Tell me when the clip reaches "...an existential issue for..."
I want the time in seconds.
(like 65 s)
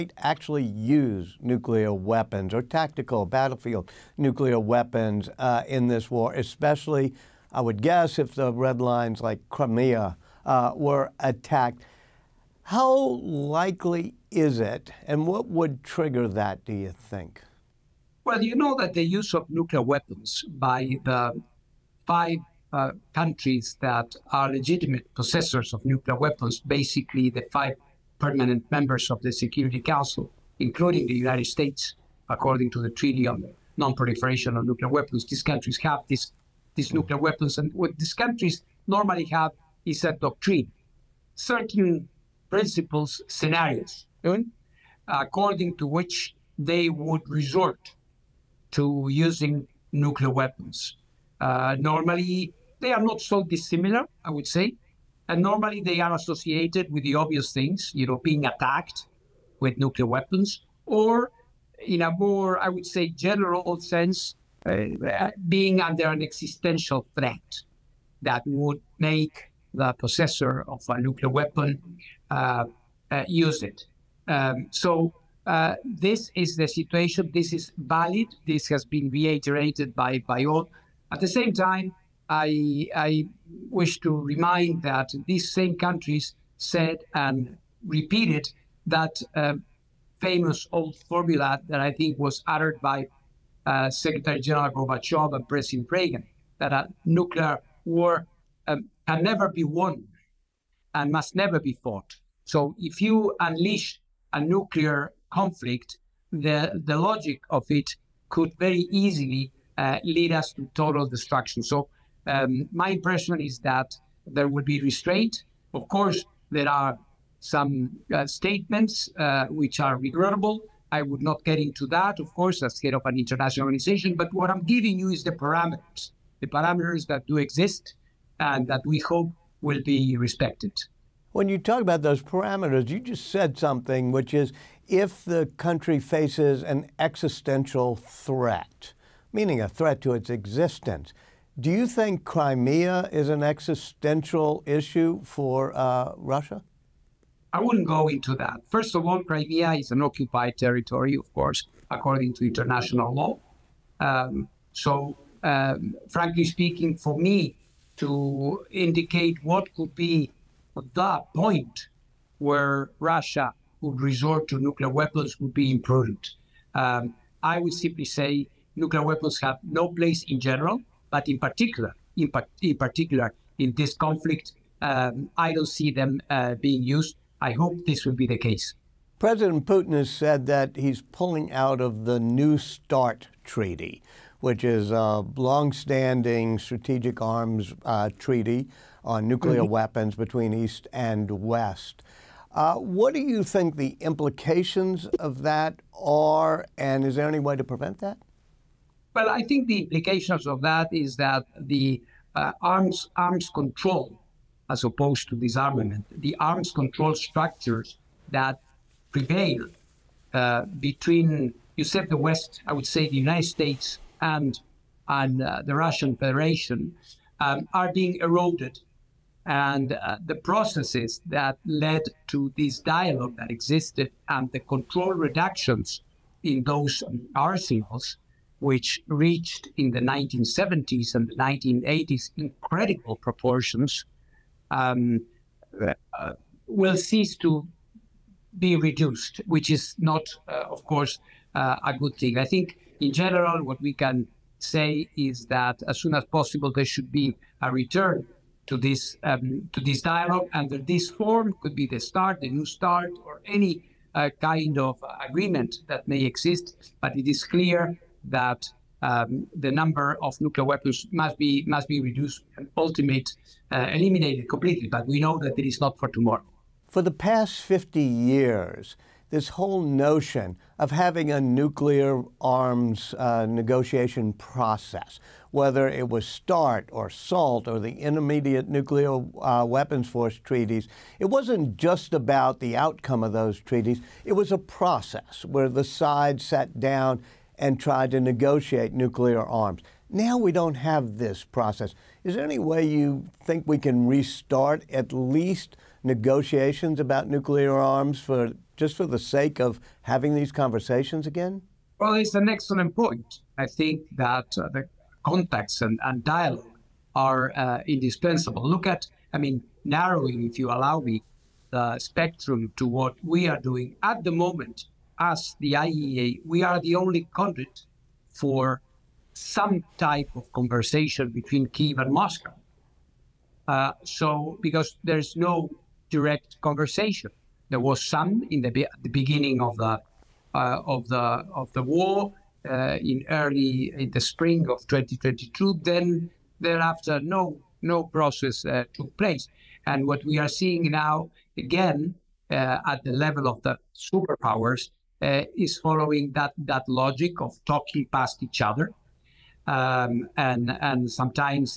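143 s.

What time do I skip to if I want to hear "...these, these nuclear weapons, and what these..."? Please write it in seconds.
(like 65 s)
36 s.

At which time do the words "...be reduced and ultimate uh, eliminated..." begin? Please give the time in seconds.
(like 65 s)
261 s.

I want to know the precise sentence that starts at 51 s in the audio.
Uh, normally, they are not so dissimilar, I would say.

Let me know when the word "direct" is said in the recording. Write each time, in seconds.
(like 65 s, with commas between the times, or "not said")
326 s.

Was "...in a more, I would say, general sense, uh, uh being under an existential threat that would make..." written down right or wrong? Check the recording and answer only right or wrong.
right.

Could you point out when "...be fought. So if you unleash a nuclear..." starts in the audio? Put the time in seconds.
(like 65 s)
101 s.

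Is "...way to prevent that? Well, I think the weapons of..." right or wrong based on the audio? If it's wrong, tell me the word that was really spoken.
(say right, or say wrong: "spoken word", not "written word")
wrong: "implications", not "weapons".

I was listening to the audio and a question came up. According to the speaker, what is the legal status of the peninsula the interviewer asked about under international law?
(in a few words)
Occupied territory.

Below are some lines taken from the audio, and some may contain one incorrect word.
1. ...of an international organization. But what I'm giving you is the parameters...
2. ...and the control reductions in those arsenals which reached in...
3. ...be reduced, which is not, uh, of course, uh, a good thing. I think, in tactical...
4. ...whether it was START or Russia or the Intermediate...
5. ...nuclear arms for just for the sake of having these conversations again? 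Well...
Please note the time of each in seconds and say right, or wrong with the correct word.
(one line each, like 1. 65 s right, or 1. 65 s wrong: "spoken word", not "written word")
1. 122 s right
2. 224 s right
3. 238 s wrong: "general", not "tactical"
4. 275 s wrong: "SALT", not "Russia"
5. 297 s right.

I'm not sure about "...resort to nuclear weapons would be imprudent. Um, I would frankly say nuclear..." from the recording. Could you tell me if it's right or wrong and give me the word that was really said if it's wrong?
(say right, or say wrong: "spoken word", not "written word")
wrong: "simply", not "frankly".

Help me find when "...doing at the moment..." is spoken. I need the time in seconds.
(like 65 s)
313 s.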